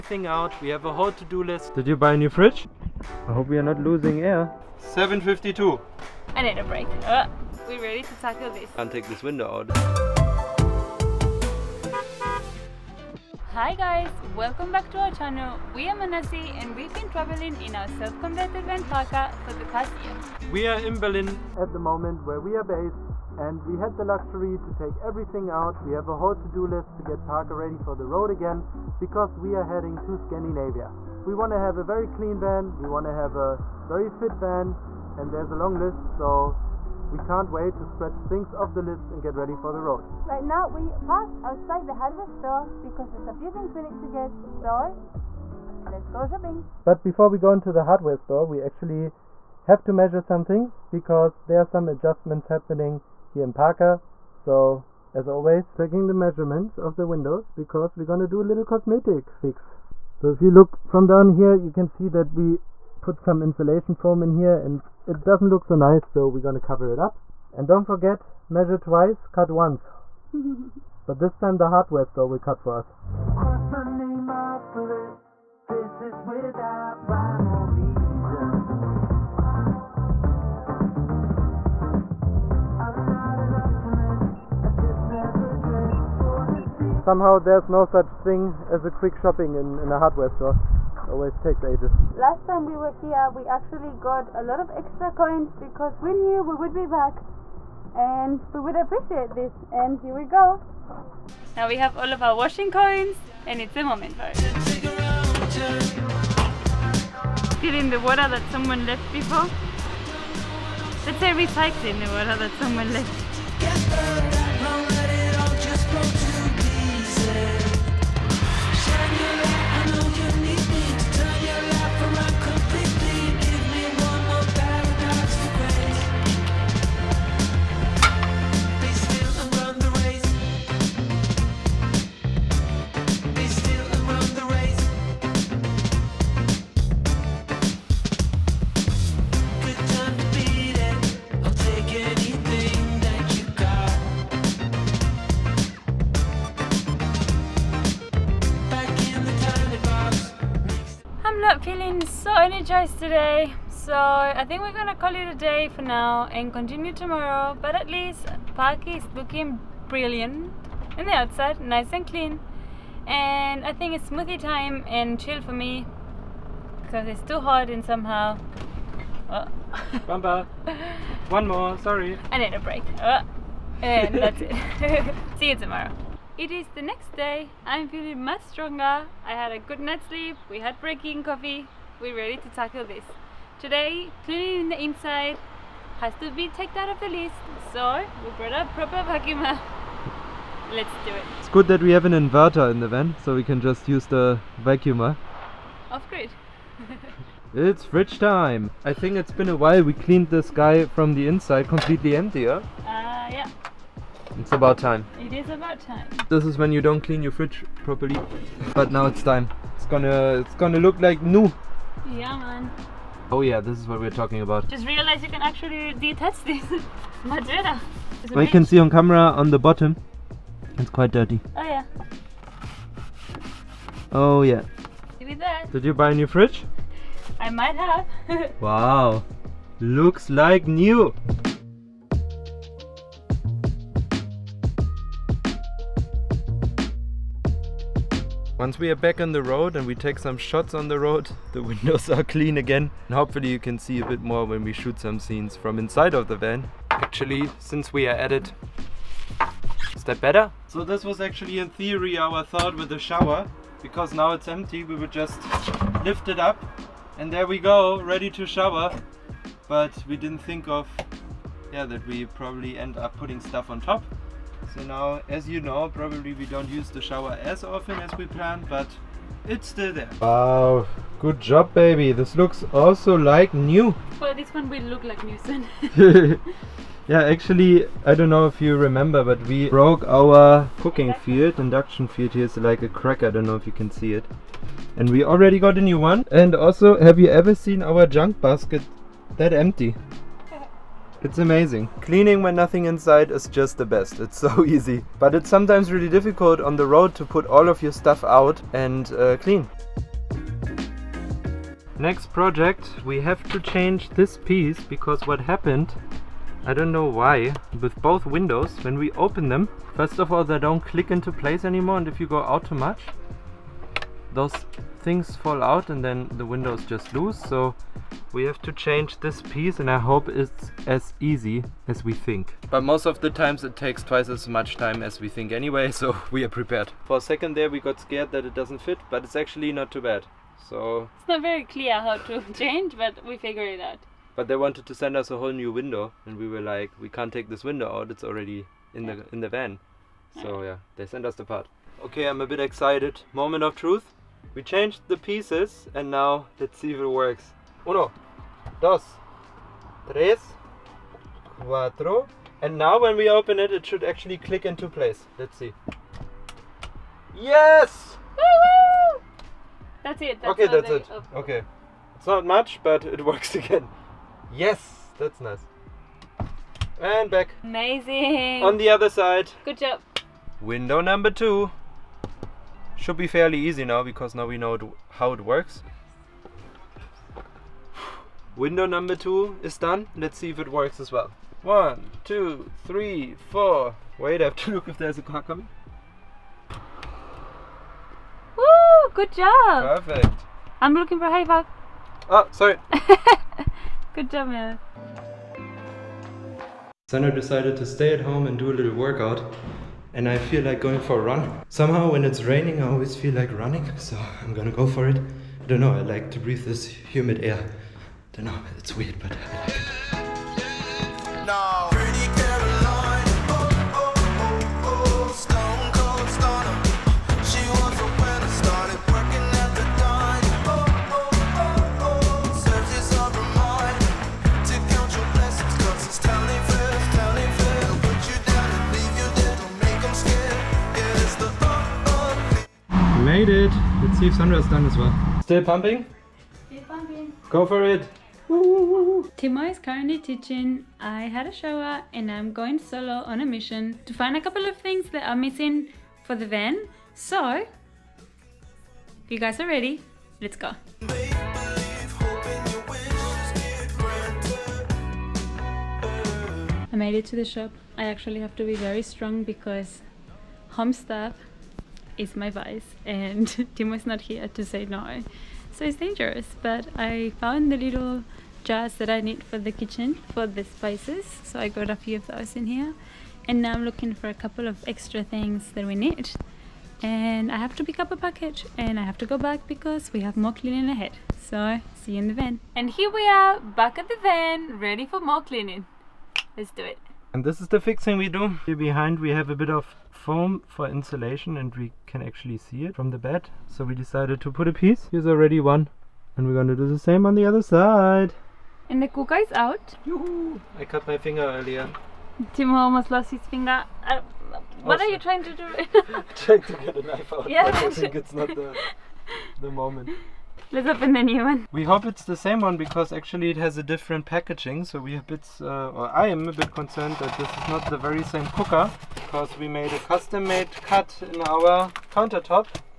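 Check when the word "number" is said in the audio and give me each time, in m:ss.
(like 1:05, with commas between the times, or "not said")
6:10, 6:18.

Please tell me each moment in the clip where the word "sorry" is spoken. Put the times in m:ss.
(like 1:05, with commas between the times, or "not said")
2:51, 6:32.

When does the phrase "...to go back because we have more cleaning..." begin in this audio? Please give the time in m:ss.
7:59.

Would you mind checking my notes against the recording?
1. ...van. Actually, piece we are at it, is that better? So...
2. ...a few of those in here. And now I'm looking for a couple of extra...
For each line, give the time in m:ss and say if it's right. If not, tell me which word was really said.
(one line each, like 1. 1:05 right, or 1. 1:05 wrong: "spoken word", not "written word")
1. 4:06 wrong: "since", not "piece"
2. 7:51 right.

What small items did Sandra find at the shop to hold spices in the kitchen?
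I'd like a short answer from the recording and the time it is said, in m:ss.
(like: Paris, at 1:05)
little jars, at 7:47.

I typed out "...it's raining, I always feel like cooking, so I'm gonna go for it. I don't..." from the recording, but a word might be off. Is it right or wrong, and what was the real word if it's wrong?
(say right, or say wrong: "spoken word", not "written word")
wrong: "running", not "cooking".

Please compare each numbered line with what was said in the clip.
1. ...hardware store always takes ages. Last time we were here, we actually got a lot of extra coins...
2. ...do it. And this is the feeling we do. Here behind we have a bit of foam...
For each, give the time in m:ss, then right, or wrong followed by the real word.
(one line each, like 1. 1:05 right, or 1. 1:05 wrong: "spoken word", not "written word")
1. 1:29 right
2. 8:06 wrong: "fixing", not "feeling".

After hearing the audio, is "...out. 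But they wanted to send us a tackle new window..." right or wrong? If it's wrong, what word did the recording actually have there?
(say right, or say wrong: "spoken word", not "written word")
wrong: "whole", not "tackle".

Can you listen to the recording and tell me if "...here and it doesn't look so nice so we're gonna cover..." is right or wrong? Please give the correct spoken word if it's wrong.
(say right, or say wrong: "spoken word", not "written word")
right.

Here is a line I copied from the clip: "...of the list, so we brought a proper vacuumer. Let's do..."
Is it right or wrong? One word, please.
right.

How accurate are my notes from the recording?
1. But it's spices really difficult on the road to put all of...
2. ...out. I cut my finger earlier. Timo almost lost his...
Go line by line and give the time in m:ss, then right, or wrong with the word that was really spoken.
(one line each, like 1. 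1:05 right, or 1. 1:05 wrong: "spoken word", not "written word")
1. 4:55 wrong: "sometimes", not "spices"
2. 8:19 right.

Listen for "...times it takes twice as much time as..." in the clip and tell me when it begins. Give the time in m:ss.
5:23.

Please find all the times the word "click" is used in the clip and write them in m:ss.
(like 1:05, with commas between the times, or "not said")
5:10, 5:54.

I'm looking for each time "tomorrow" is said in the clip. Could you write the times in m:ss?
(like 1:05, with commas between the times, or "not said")
2:36, 2:55.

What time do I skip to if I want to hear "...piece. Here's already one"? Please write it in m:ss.
8:14.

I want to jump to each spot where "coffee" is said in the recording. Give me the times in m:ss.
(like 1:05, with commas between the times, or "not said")
3:01.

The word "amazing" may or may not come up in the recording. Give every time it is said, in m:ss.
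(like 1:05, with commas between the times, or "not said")
4:51, 6:07.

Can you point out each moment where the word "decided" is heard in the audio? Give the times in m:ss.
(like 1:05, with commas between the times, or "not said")
6:37, 8:13.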